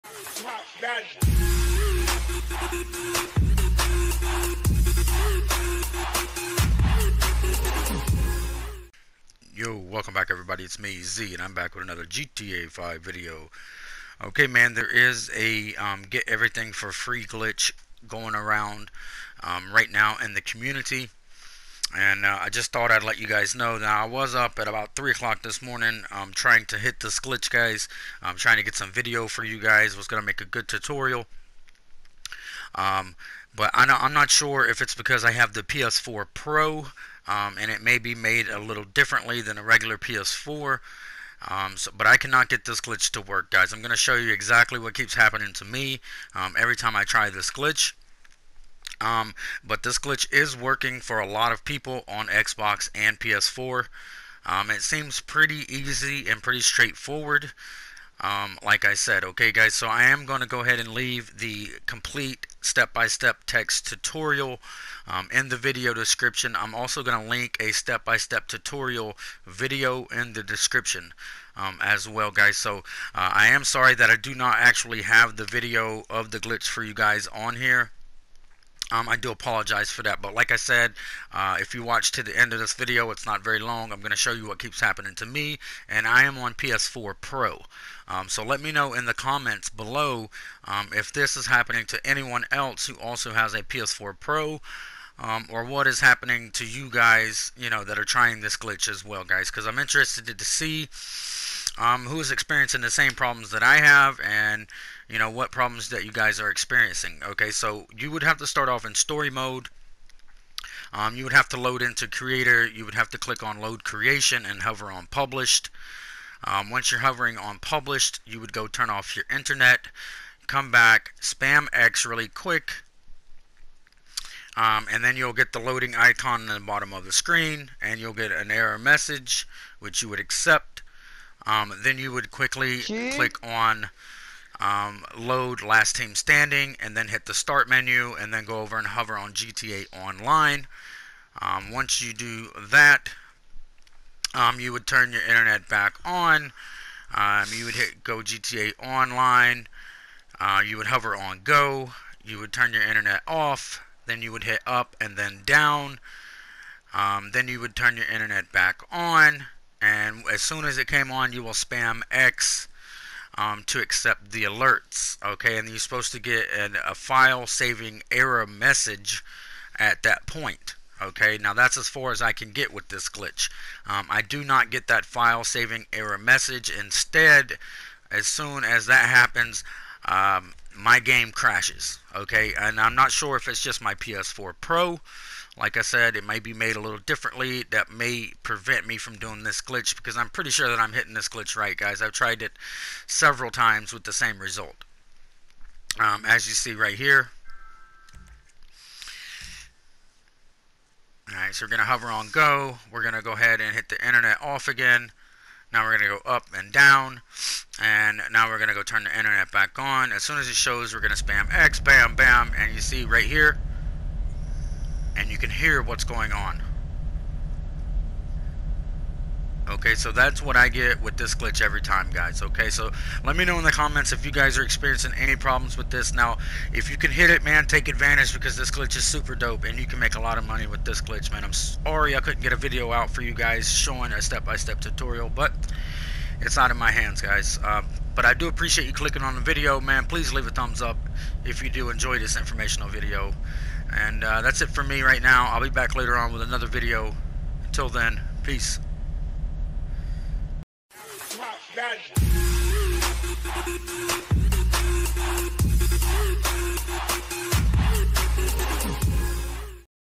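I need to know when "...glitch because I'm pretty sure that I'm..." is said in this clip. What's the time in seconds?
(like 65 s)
189 s.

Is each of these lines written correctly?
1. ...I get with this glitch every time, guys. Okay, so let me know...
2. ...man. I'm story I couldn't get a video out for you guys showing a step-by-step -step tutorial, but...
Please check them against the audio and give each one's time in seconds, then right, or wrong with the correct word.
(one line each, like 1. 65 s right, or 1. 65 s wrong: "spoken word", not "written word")
1. 220 s right
2. 231 s wrong: "sorry", not "story".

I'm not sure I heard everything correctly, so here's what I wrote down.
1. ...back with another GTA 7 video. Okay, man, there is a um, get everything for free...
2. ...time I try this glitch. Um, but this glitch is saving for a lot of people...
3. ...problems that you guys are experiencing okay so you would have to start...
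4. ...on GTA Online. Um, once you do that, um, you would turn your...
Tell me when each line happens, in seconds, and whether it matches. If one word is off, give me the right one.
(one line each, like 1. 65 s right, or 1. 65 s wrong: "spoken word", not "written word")
1. 11 s wrong: "5", not "7"
2. 46 s wrong: "working", not "saving"
3. 105 s right
4. 139 s right.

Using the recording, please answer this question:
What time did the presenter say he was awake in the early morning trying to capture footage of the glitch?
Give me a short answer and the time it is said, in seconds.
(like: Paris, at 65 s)
3 o'clock, at 24 s.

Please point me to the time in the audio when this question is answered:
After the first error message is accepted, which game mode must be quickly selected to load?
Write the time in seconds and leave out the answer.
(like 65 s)
135 s.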